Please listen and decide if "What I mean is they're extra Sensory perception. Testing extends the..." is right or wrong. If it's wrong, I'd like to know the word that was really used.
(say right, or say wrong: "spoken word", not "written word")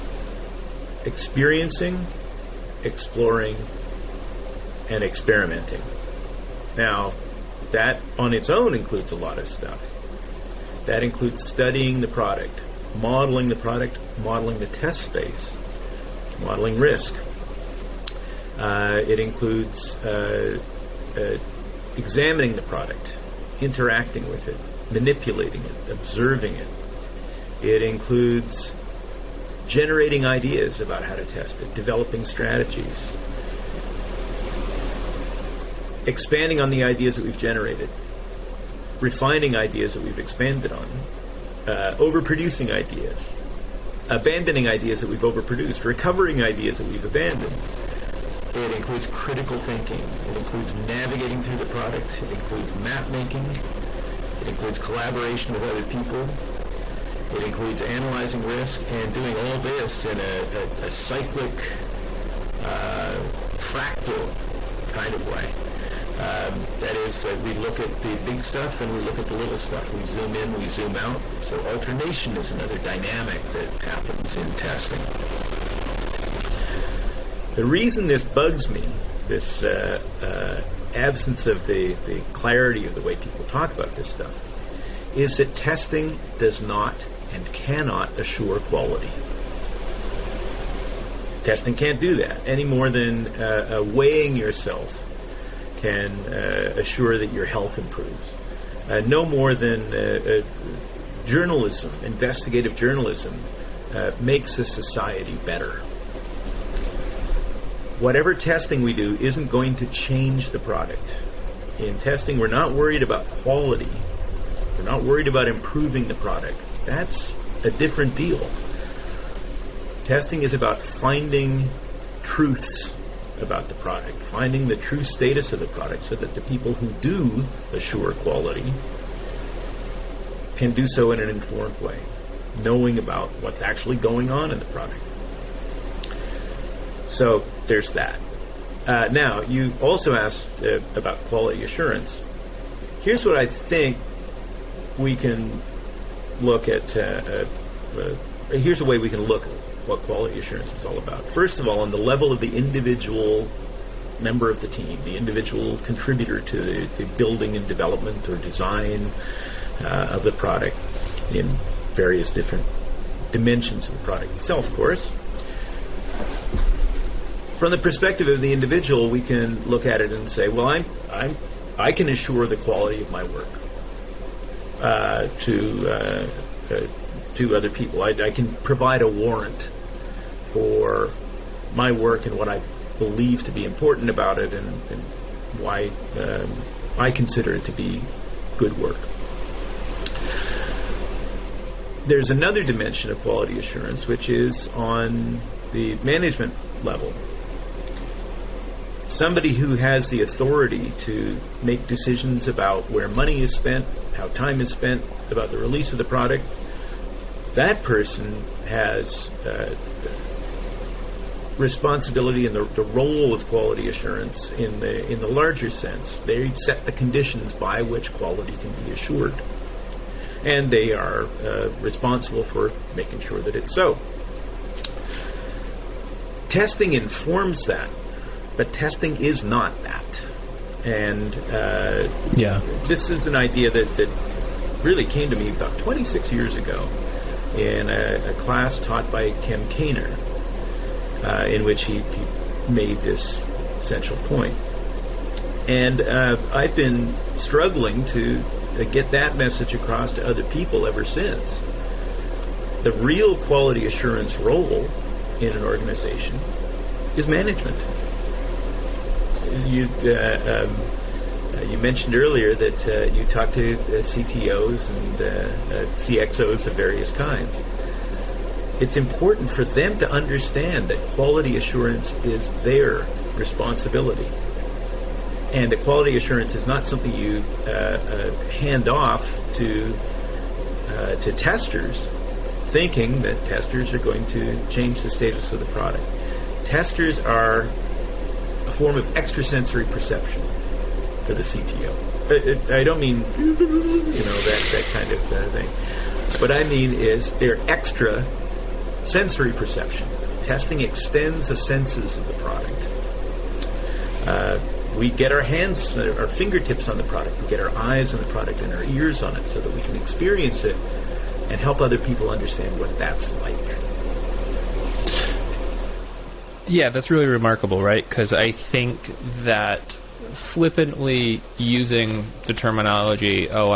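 right.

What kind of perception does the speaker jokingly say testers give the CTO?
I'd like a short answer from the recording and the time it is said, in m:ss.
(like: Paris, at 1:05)
Extrasensory perception, at 4:49.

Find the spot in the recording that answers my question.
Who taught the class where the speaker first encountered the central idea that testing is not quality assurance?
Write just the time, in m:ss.
3:59.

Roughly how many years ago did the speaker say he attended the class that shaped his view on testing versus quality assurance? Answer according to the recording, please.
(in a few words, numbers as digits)
26.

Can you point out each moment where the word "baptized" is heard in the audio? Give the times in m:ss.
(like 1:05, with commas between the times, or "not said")
not said.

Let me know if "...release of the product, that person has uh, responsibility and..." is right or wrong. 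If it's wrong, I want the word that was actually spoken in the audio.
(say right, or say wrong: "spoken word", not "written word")
right.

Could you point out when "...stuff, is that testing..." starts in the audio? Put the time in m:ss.
1:24.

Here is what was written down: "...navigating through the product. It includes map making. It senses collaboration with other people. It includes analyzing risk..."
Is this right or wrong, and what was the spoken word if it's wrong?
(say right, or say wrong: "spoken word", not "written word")
wrong: "includes", not "senses".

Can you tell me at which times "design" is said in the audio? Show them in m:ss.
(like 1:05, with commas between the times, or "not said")
2:38.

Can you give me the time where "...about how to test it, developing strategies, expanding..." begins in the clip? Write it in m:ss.
0:30.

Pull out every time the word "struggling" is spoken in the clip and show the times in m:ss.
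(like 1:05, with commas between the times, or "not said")
4:07.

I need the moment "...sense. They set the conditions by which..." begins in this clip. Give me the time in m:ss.
3:35.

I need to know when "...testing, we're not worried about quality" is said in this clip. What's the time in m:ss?
1:51.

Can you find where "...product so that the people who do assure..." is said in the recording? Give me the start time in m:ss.
2:05.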